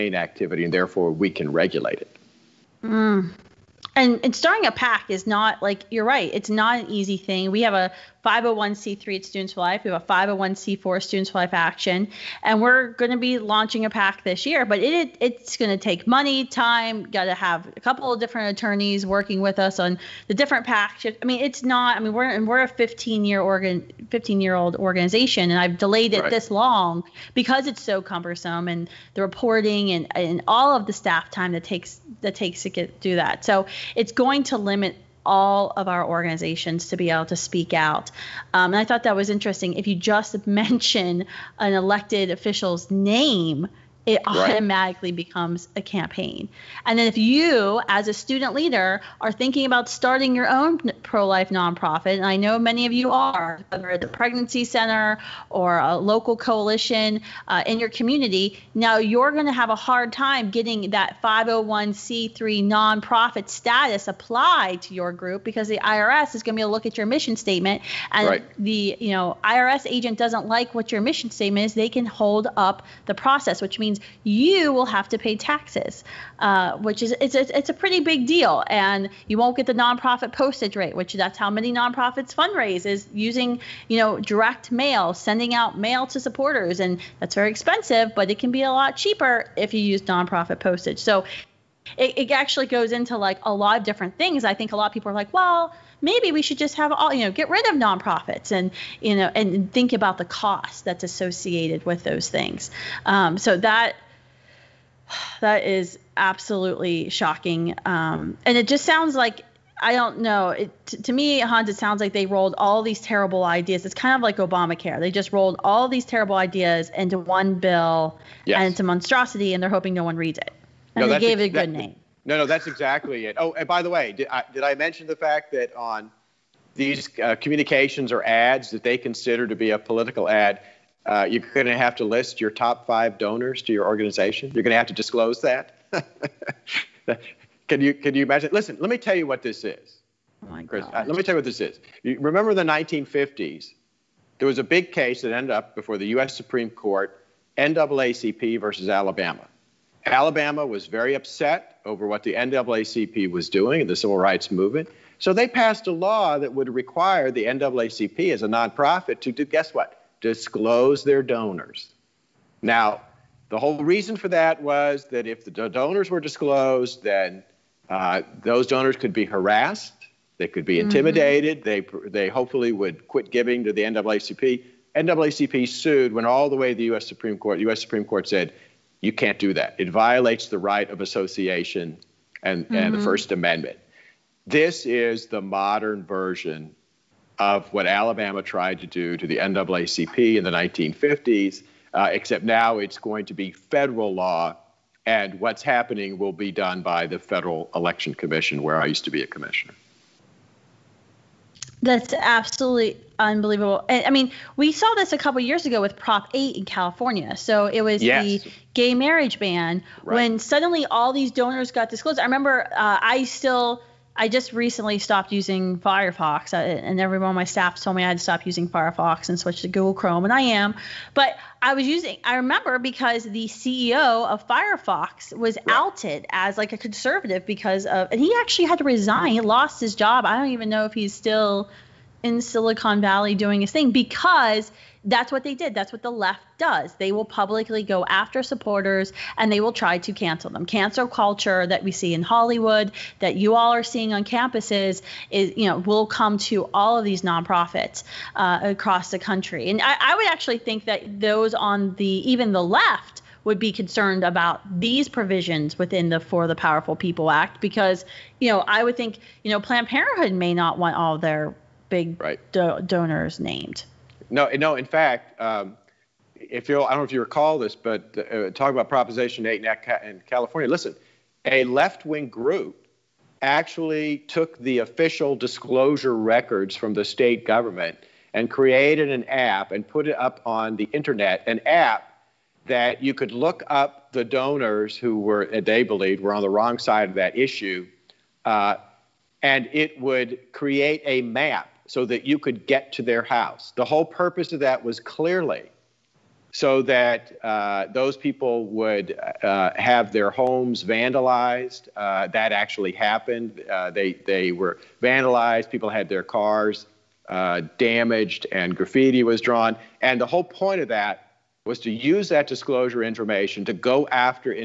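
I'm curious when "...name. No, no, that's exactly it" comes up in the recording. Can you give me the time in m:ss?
2:01.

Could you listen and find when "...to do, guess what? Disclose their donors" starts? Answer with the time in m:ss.
2:39.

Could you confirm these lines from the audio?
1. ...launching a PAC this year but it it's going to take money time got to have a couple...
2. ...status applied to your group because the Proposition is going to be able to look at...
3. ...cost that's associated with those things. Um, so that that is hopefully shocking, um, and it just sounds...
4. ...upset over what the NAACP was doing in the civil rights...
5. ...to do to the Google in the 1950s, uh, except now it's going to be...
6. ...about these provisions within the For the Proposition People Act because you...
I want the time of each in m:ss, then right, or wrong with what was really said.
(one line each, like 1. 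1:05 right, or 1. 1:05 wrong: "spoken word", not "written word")
1. 0:13 right
2. 1:03 wrong: "IRS", not "Proposition"
3. 1:40 wrong: "absolutely", not "hopefully"
4. 2:31 right
5. 3:08 wrong: "NAACP", not "Google"
6. 4:14 wrong: "Powerful", not "Proposition".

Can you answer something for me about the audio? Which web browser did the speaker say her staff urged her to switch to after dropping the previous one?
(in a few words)
Google Chrome.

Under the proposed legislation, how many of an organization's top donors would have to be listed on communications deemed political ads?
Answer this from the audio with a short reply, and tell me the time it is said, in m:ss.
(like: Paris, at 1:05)
5, at 2:12.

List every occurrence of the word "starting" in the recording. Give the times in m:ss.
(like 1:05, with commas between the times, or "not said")
0:04, 0:49.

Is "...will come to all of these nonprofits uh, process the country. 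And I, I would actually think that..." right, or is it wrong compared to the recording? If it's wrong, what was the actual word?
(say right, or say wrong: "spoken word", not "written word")
wrong: "across", not "process".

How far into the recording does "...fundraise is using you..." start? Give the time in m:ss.
1:22.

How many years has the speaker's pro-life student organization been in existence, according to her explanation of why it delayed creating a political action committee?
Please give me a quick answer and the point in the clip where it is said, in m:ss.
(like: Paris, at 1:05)
15, at 0:24.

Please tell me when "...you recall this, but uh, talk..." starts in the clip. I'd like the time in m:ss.
4:27.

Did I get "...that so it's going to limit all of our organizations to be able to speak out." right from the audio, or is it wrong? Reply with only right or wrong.
right.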